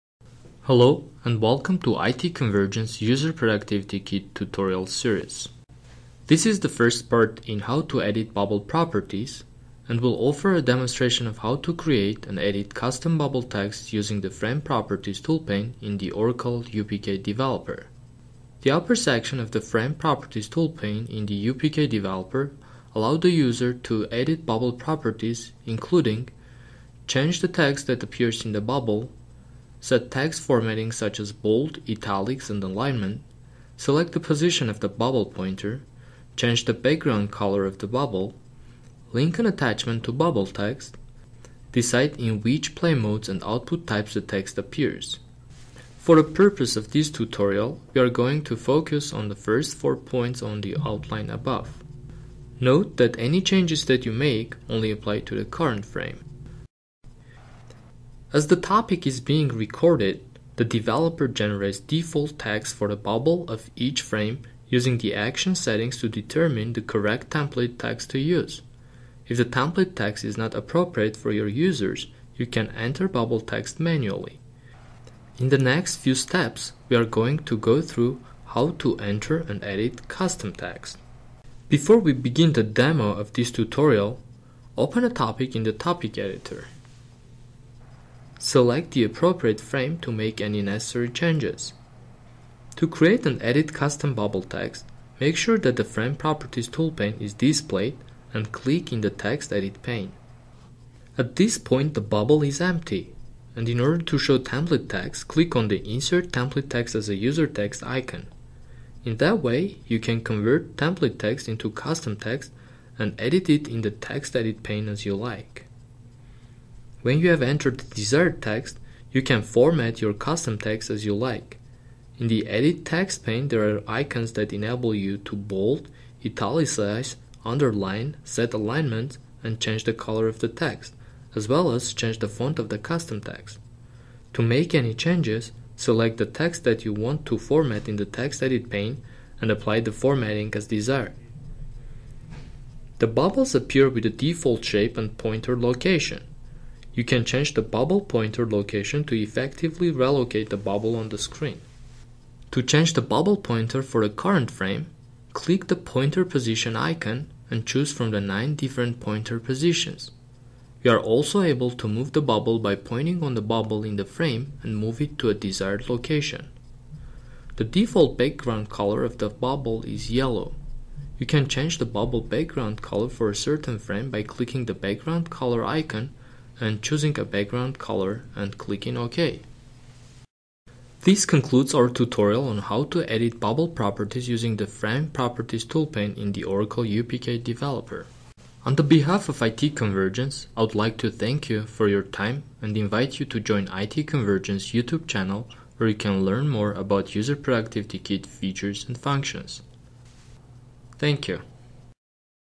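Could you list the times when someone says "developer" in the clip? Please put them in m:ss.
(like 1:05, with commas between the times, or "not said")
0:17, 0:21, 1:00, 3:07.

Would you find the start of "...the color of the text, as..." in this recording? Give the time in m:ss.
2:09.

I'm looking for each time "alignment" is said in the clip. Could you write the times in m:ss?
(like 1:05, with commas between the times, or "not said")
0:32, 2:08.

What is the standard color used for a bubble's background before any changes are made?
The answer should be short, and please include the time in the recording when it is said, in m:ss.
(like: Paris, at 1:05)
Yellow, at 2:50.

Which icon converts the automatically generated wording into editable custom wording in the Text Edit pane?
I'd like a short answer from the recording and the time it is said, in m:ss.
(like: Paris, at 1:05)
Insert Template Text as a User Text, at 1:45.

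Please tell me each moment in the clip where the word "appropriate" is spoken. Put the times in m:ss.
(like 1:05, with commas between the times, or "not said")
1:10, 1:29.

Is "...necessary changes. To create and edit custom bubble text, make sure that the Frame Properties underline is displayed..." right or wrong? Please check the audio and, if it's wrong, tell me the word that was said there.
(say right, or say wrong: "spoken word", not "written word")
wrong: "toolpane", not "underline".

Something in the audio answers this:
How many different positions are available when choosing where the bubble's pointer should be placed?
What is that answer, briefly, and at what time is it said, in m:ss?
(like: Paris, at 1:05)
9, at 2:38.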